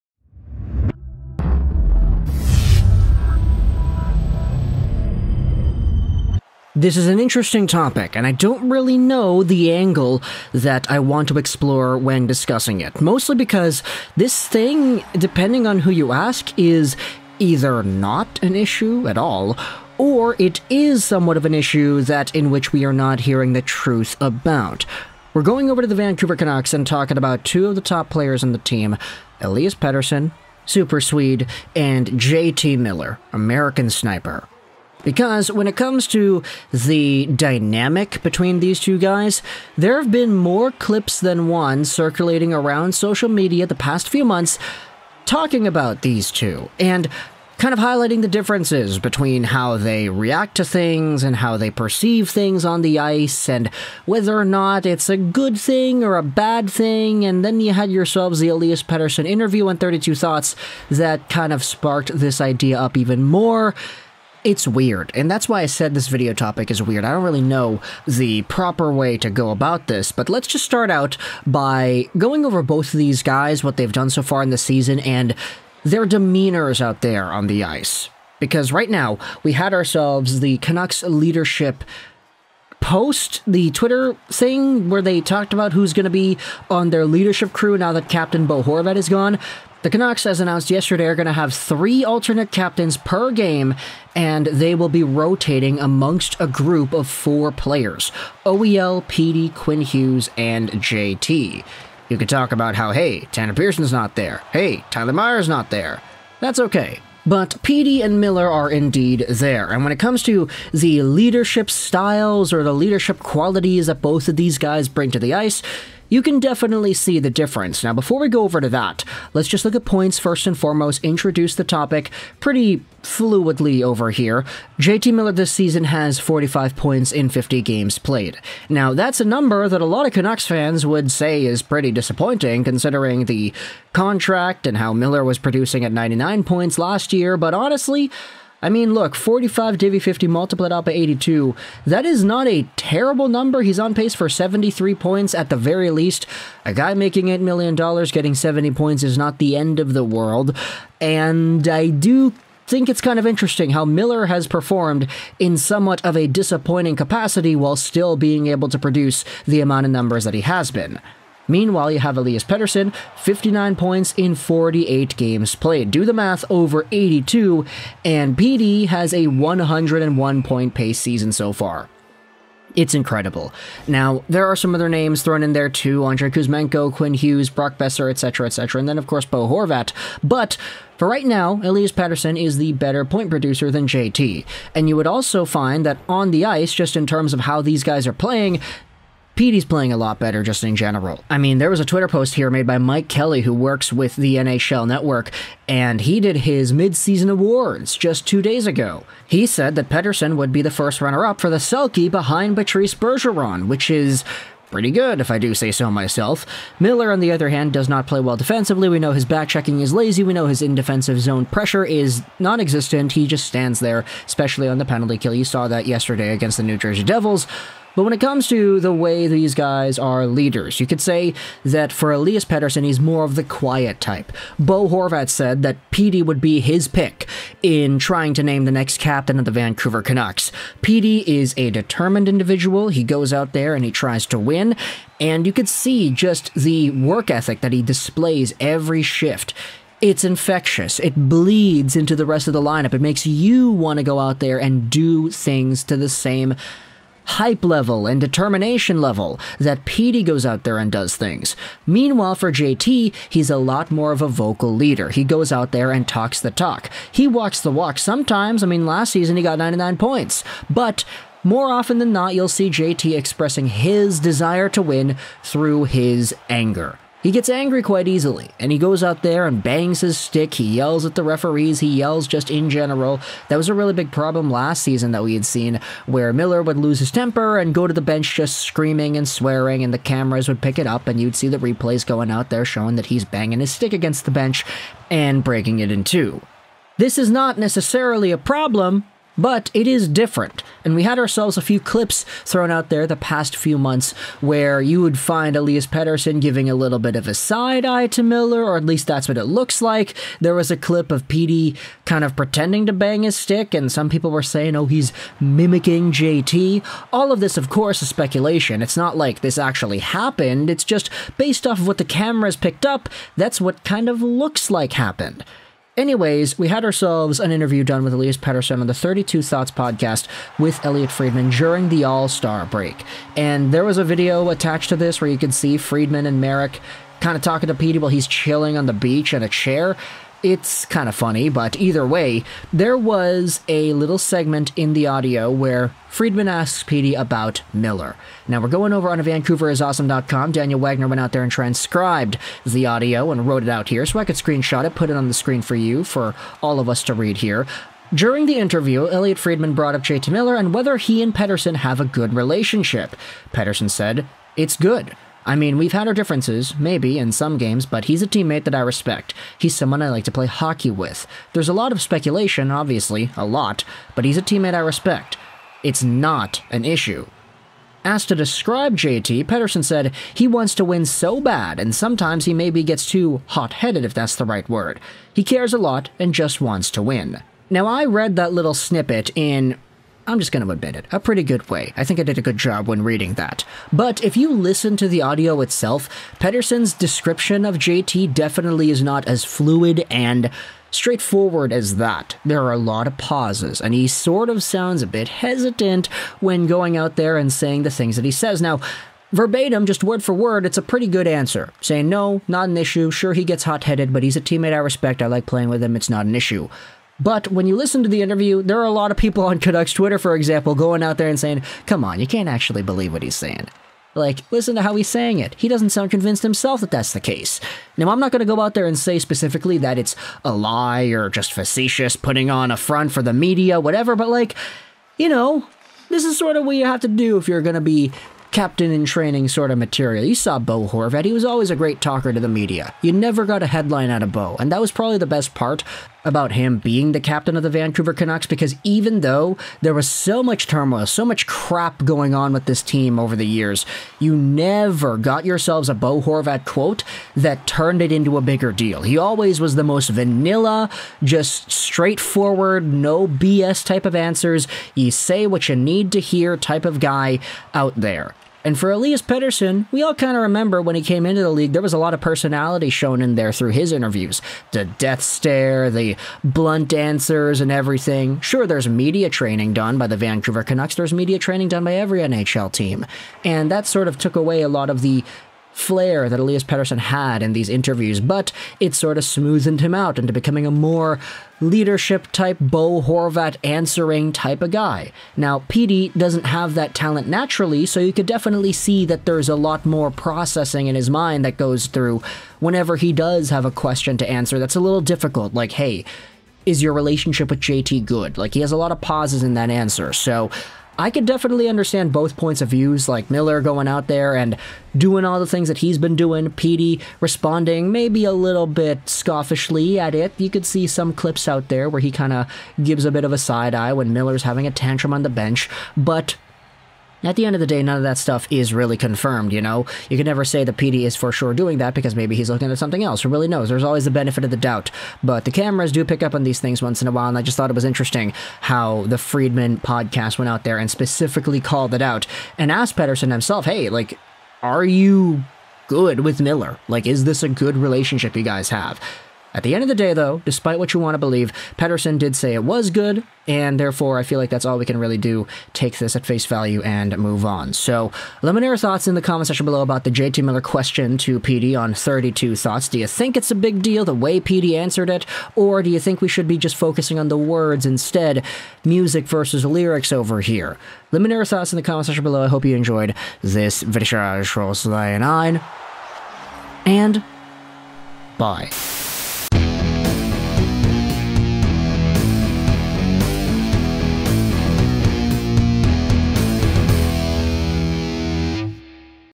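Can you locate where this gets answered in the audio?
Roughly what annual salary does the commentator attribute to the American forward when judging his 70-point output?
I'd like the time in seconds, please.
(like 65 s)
147 s.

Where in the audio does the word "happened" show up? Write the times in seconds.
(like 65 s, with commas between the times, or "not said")
309 s, 314 s.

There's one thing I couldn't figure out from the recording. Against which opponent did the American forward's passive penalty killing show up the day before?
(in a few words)
New Jersey Devils.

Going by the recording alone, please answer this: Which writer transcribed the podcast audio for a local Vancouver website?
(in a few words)
Daniel Wagner.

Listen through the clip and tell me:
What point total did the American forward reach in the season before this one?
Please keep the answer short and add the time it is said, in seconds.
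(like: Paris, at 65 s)
99, at 135 s.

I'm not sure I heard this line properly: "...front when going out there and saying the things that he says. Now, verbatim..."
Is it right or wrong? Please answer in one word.
wrong.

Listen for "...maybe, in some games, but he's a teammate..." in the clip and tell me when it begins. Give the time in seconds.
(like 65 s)
356 s.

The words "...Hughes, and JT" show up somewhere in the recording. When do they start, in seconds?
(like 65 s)
99 s.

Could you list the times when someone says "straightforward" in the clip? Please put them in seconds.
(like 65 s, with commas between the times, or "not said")
390 s, 451 s.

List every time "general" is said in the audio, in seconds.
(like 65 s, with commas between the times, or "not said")
190 s, 272 s.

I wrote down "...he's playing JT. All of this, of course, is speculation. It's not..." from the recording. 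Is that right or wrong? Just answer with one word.
wrong.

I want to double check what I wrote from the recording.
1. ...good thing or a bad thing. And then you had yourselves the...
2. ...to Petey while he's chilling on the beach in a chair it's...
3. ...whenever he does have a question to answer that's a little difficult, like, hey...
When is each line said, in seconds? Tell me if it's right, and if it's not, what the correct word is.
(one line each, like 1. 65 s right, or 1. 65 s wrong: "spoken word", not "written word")
1. 55 s right
2. 327 s right
3. 492 s right.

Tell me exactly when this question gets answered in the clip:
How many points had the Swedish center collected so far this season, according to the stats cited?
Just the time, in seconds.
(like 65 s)
163 s.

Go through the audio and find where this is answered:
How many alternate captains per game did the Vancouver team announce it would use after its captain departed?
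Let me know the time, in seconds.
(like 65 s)
91 s.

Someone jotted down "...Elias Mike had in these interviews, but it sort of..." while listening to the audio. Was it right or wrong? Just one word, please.
wrong.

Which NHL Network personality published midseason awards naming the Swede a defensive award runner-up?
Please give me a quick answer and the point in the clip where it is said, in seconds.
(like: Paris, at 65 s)
Mike Kelly, at 192 s.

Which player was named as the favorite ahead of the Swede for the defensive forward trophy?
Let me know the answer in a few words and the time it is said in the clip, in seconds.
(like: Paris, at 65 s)
Patrice Bergeron, at 202 s.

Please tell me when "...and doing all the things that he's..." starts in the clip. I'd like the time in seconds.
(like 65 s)
504 s.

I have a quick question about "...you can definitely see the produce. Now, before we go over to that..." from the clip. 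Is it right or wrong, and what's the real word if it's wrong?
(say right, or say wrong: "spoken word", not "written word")
wrong: "difference", not "produce".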